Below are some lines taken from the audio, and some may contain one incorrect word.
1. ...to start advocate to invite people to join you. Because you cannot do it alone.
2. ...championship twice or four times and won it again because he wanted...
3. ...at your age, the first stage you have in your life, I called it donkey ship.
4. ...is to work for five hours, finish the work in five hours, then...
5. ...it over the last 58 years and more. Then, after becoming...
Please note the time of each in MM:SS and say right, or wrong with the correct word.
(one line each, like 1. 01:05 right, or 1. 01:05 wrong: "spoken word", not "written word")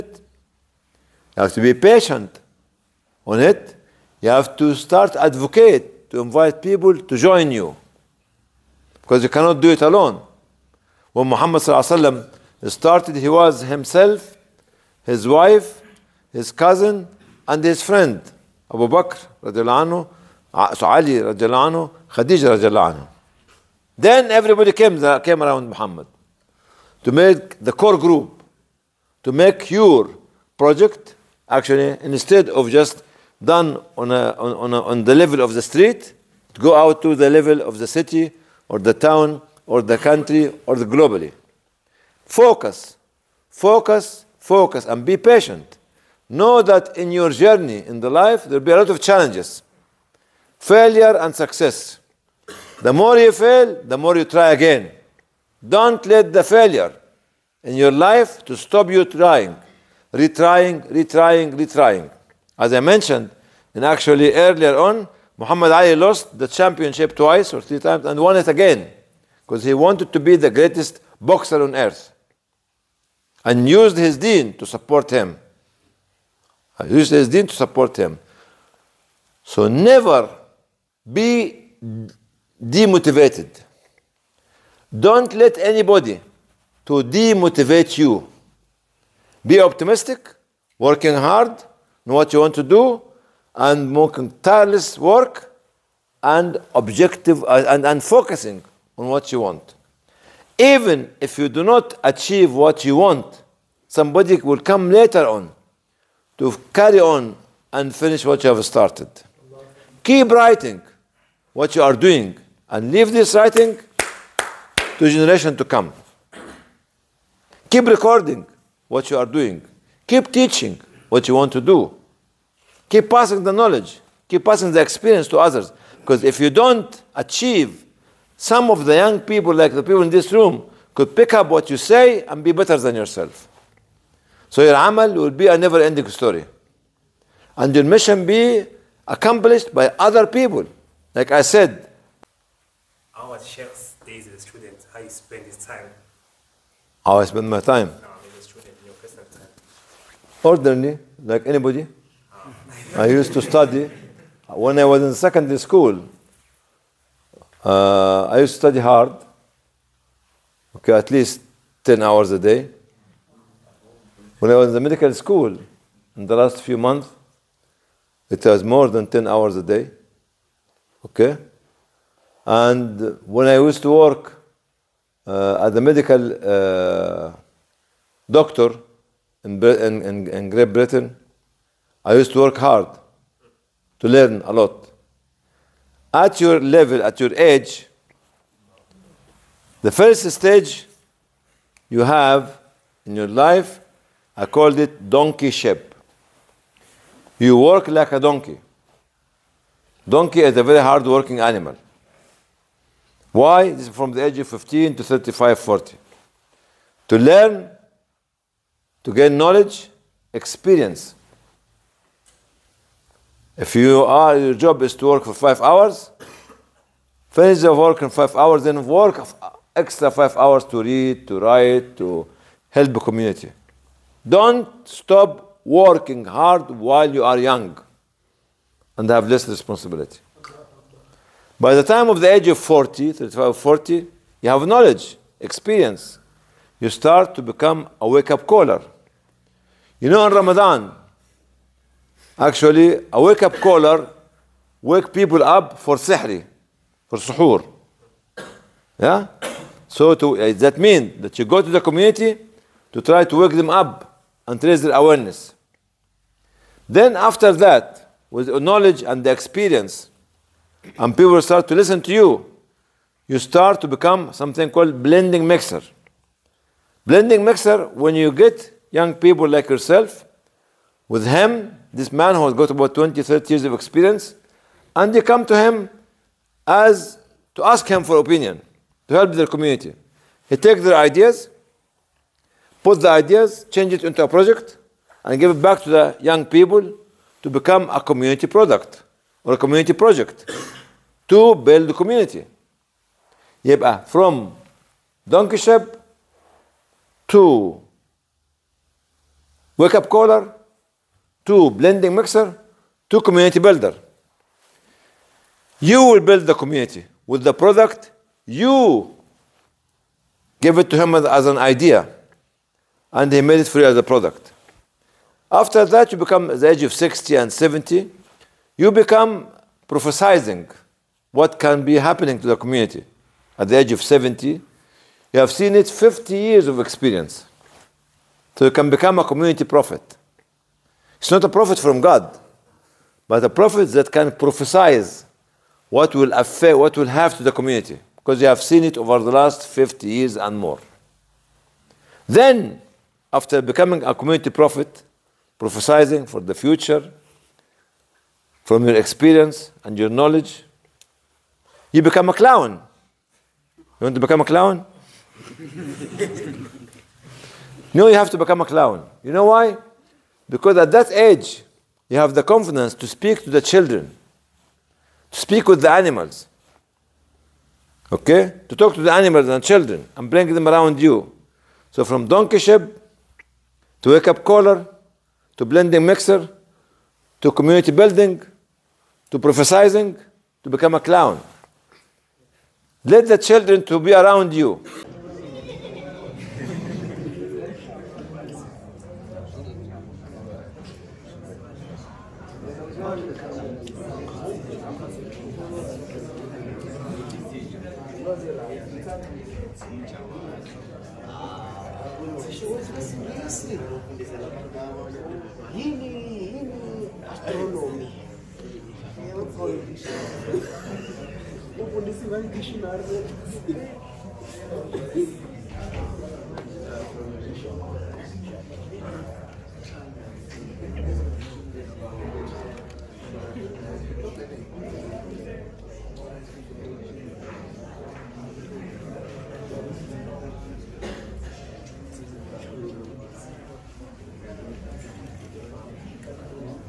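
1. 00:04 right
2. 01:06 wrong: "three", not "four"
3. 03:07 right
4. 03:34 right
5. 05:38 wrong: "50", not "58".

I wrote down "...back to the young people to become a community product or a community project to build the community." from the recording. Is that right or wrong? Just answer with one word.
right.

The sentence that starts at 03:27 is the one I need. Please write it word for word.
To learn, to gain knowledge, experience.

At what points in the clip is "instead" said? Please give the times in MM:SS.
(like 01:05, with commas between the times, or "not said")
00:32.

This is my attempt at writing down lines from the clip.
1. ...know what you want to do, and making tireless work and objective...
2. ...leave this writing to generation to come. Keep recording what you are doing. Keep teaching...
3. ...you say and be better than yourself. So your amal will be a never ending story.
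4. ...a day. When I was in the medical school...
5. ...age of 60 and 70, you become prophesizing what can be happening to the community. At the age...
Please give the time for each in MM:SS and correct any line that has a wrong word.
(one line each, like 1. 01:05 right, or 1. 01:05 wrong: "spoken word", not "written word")
1. 01:32 right
2. 01:52 right
3. 02:11 right
4. 02:42 right
5. 05:16 right.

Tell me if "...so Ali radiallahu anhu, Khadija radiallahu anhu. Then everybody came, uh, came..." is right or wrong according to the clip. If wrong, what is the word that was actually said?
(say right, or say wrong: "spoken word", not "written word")
right.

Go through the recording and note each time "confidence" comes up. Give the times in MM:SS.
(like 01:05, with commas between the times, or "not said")
06:02.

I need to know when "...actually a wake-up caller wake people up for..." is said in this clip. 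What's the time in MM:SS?
04:02.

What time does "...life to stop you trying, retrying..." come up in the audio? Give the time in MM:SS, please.
00:57.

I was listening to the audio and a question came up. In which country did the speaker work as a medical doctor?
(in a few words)
Great Britain.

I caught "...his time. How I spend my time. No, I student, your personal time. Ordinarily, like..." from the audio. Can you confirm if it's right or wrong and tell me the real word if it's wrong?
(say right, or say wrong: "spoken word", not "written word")
right.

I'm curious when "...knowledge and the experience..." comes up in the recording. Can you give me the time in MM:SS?
04:18.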